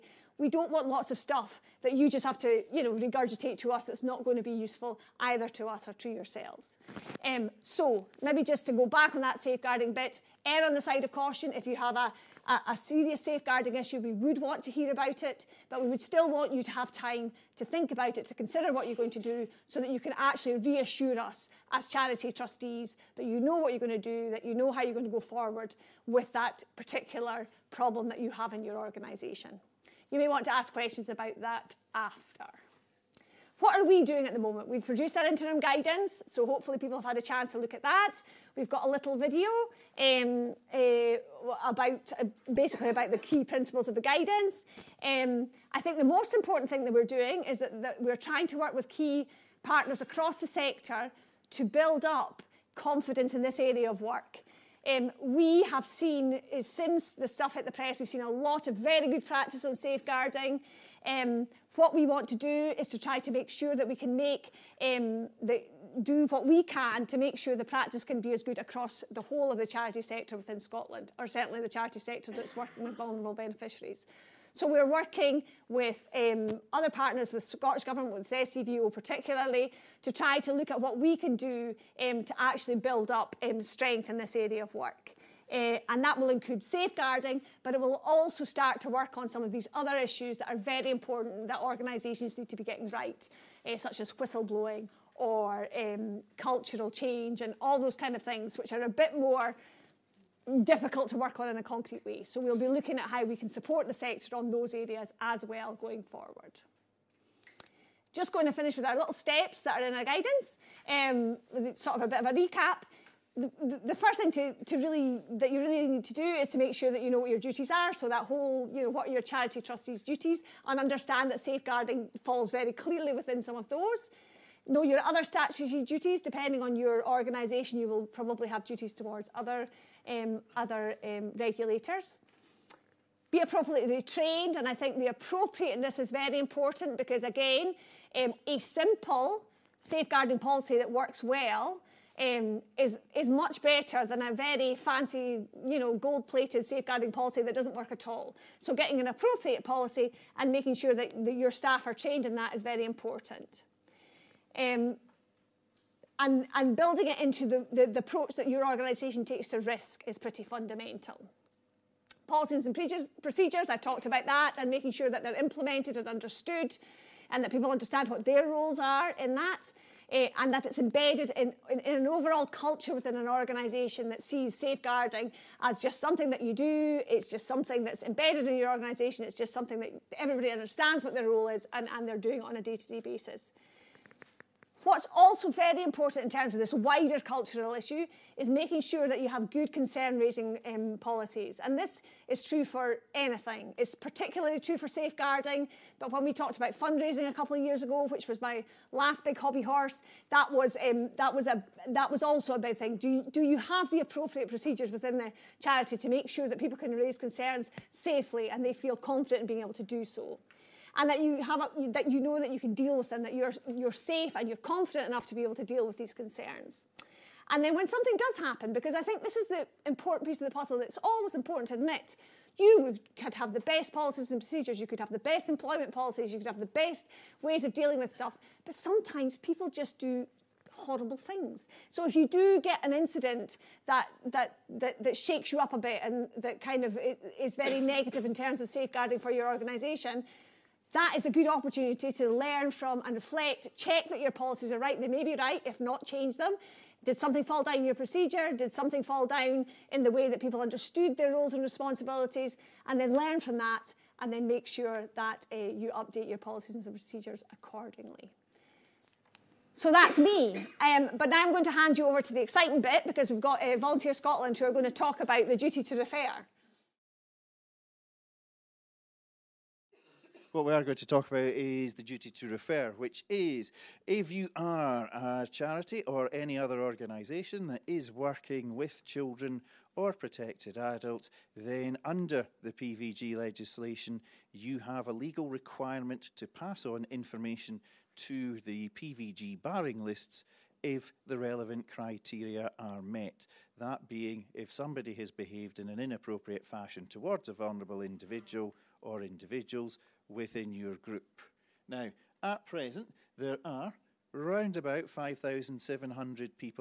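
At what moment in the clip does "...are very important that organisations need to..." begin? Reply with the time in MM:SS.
01:30.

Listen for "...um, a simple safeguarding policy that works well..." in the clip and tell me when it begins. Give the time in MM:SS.
02:18.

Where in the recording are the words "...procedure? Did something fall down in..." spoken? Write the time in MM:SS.
04:07.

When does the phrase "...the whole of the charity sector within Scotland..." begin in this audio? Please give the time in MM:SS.
01:09.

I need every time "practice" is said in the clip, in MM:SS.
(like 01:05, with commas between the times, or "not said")
00:59, 01:07.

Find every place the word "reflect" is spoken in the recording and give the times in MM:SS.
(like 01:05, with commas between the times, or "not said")
04:03.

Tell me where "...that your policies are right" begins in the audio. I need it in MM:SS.
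04:04.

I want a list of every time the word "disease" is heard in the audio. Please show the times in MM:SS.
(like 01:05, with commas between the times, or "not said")
not said.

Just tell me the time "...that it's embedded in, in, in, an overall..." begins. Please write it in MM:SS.
02:50.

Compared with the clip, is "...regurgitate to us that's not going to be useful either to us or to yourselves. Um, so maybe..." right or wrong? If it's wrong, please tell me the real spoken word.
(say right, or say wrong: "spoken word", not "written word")
right.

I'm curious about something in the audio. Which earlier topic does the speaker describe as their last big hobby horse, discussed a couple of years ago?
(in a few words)
Fundraising.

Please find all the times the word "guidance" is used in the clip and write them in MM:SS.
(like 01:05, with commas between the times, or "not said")
00:35, 00:43, 01:50.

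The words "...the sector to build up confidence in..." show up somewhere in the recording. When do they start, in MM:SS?
00:50.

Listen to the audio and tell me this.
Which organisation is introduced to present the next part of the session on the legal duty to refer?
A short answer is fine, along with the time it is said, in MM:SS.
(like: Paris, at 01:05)
Volunteer Scotland, at 04:23.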